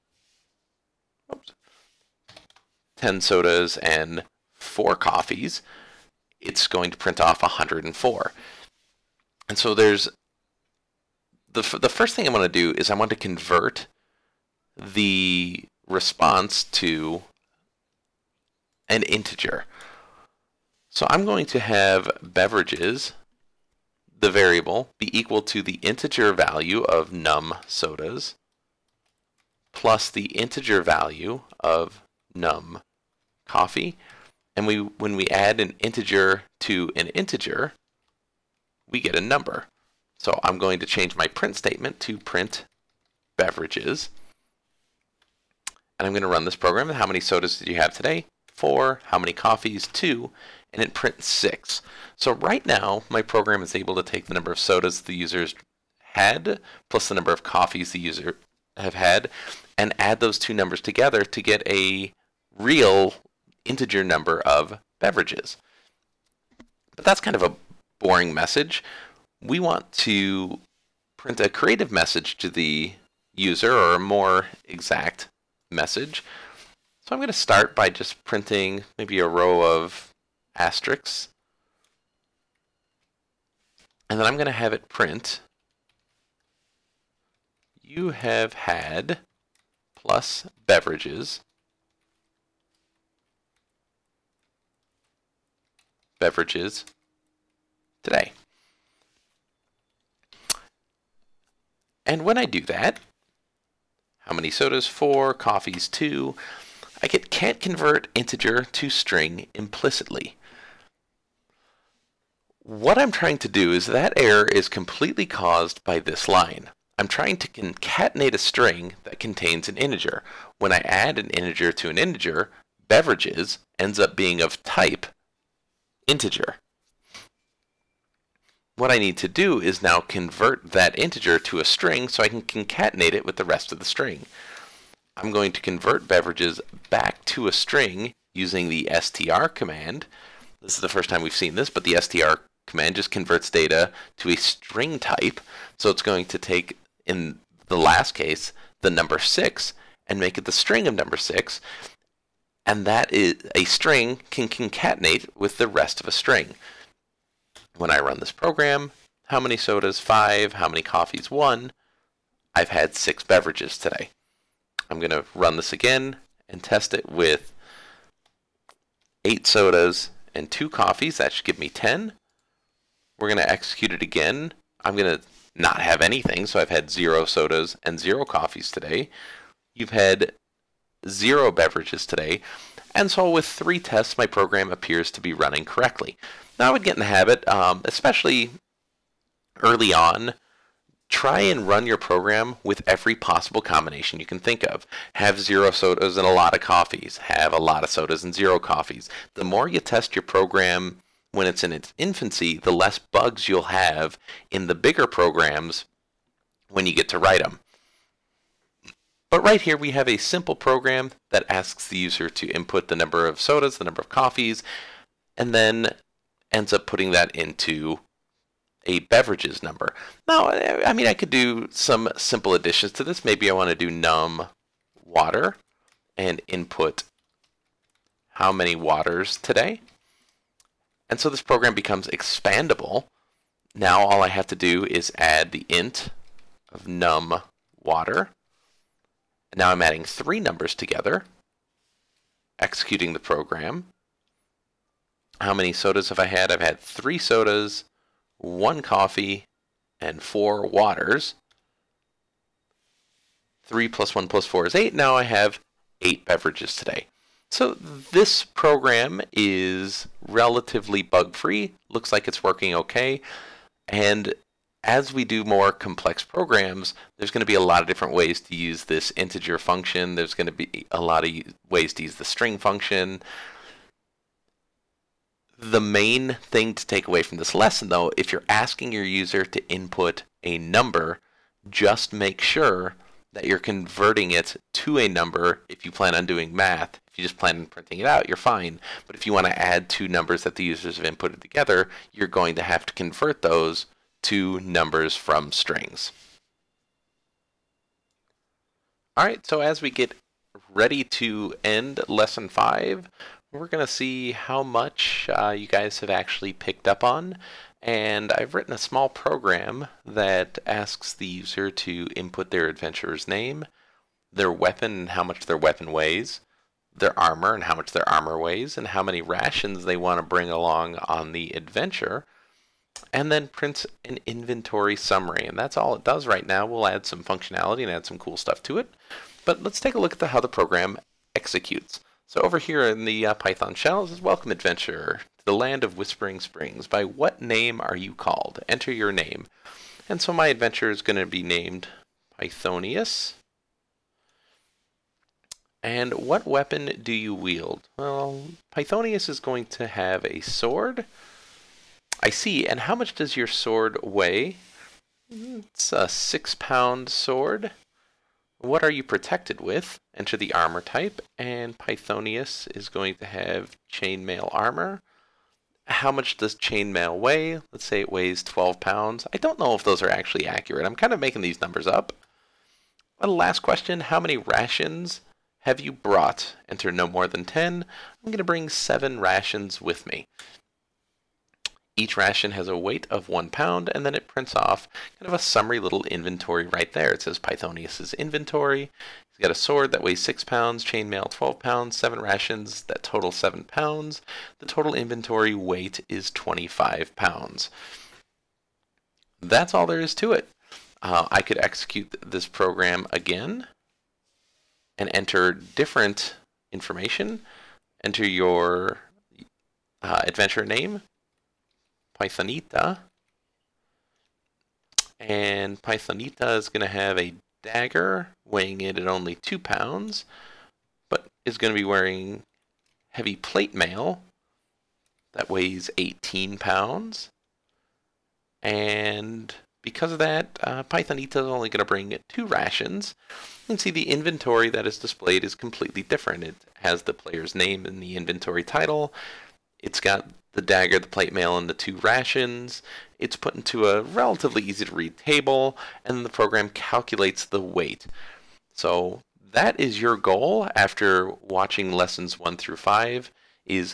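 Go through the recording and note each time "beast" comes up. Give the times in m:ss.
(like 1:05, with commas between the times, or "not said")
not said.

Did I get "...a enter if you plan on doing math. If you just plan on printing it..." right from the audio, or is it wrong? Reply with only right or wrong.
wrong.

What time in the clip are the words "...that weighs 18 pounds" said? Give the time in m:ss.
7:05.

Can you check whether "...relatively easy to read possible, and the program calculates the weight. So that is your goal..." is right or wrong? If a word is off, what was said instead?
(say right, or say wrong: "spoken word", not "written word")
wrong: "table", not "possible".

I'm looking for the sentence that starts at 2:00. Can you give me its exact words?
When I add an integer to an integer, beverages ends up being of type integer.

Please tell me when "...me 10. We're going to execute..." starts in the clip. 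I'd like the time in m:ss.
2:51.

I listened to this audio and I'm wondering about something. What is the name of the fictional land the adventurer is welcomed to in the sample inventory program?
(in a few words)
Whispering Springs.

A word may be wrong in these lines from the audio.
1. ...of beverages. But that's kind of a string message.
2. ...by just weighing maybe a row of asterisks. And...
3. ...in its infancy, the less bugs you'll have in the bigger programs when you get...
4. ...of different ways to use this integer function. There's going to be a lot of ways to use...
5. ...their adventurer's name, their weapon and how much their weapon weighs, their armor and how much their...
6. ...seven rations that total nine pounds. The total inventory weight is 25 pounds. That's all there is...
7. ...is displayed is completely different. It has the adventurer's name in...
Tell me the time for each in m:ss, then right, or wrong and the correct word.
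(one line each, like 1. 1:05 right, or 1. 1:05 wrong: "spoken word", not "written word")
1. 1:04 wrong: "boring", not "string"
2. 1:17 wrong: "printing", not "weighing"
3. 3:21 right
4. 4:27 right
5. 5:12 right
6. 6:31 wrong: "seven", not "nine"
7. 7:14 wrong: "player", not "adventurer".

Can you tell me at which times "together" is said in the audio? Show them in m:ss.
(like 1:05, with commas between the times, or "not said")
1:00, 4:00, 4:51.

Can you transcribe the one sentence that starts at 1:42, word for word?
And when I do that, how many sodas?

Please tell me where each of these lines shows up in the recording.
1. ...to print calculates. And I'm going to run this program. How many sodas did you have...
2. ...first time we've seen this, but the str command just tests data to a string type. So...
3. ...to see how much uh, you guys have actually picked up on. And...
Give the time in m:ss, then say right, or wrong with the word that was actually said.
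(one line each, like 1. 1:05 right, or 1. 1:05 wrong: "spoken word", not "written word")
1. 0:42 wrong: "beverages", not "calculates"
2. 2:20 wrong: "converts", not "tests"
3. 5:03 right.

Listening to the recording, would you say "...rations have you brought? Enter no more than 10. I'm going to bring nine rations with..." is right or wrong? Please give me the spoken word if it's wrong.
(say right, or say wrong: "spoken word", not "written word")
wrong: "seven", not "nine".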